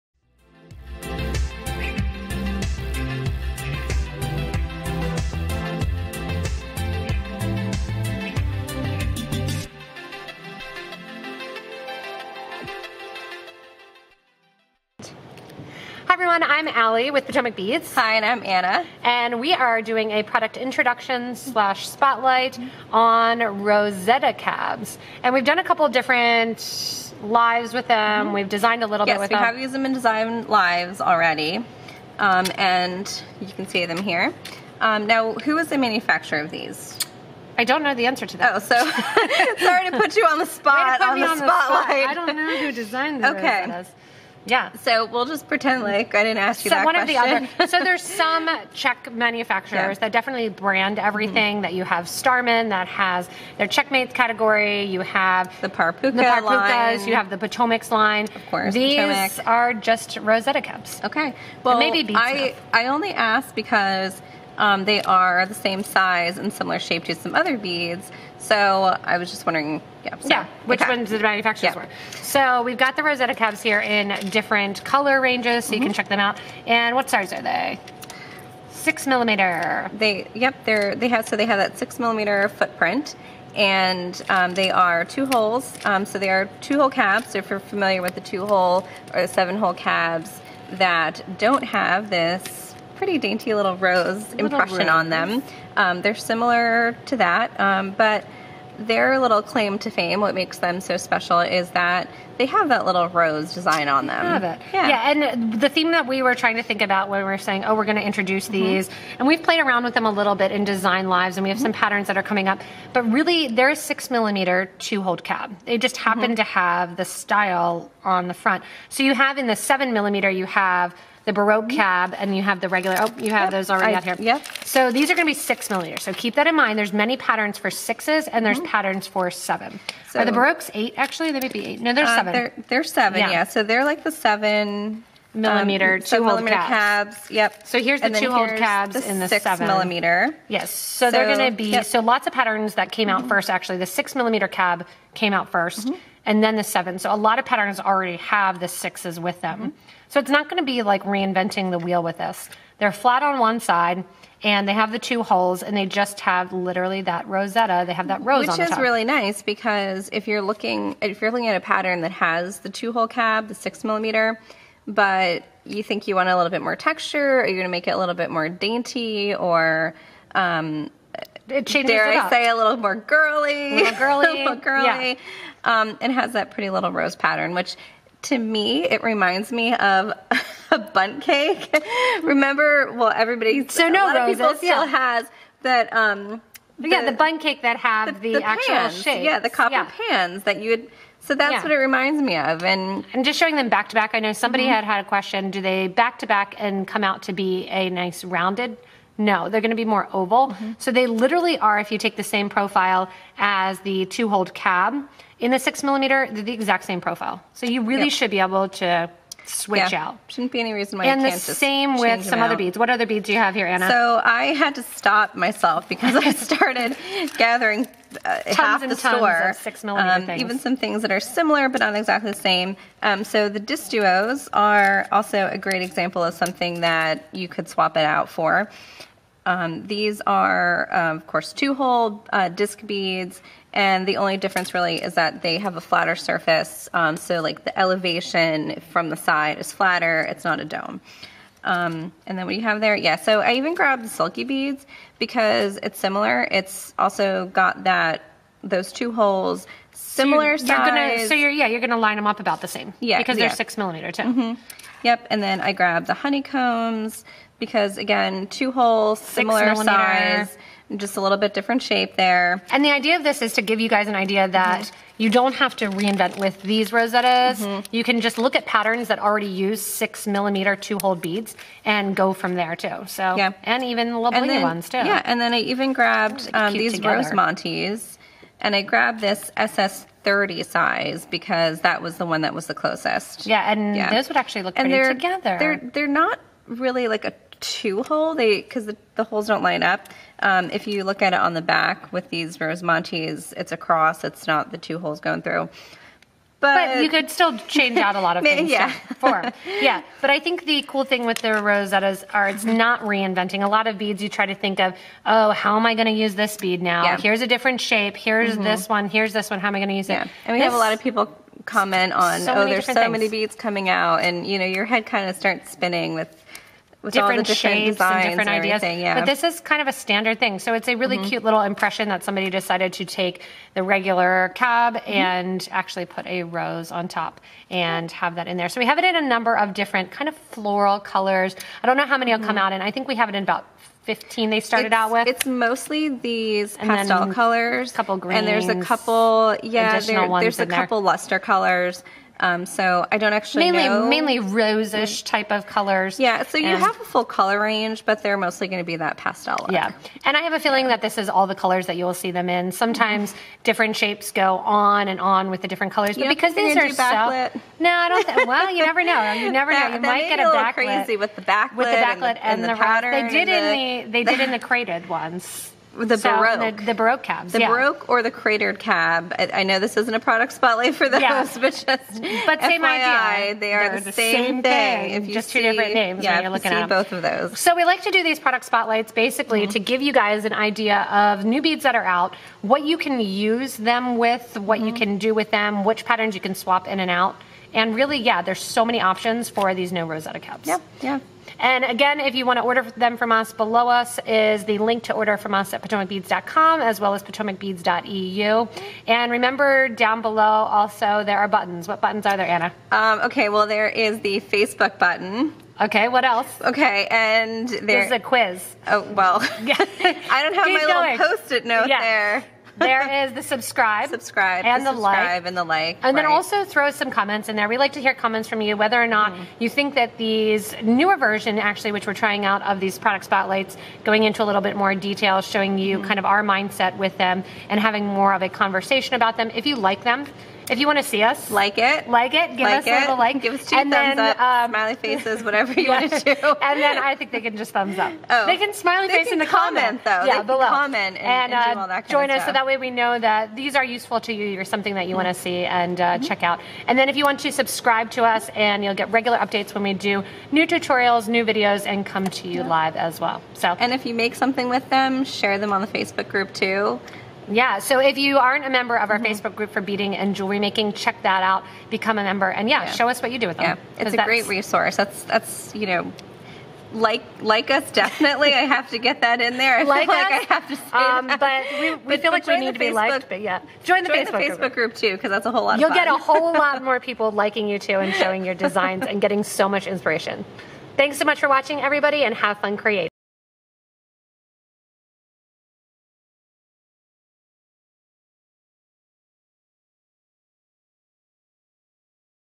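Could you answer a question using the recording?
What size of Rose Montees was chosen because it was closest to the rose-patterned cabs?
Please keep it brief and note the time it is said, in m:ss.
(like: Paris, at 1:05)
SS 30, at 4:39.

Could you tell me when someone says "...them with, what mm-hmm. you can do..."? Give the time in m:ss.
6:23.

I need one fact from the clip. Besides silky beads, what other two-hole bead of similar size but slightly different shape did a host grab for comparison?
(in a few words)
honeycombs.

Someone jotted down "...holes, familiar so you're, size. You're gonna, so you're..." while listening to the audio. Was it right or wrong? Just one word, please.
wrong.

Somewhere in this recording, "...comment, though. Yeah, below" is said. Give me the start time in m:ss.
7:19.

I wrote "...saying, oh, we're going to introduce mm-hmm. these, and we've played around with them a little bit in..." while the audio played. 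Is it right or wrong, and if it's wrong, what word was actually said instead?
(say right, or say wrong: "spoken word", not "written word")
right.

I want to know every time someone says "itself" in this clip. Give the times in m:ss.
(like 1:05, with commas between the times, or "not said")
not said.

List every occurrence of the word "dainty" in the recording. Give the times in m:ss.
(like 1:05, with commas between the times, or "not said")
1:33, 2:48.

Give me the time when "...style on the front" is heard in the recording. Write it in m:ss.
1:57.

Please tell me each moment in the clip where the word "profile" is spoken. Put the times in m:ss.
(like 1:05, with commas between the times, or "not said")
3:22, 3:27.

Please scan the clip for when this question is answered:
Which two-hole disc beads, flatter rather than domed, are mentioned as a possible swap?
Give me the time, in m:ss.
3:43.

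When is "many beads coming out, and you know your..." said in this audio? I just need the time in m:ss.
5:13.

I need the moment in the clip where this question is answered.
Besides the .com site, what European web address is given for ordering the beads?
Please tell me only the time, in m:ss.
6:37.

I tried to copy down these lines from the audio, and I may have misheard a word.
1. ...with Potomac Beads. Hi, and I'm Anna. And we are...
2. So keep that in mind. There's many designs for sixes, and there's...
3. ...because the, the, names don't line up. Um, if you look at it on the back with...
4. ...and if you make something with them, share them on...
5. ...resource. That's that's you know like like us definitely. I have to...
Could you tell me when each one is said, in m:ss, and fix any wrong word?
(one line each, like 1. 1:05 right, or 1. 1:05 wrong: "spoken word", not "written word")
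1. 0:17 right
2. 2:06 wrong: "patterns", not "designs"
3. 4:48 wrong: "holes", not "names"
4. 7:33 right
5. 7:44 right.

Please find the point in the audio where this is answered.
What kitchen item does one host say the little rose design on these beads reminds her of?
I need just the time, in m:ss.
3:00.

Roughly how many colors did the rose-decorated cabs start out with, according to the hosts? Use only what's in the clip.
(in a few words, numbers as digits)
15.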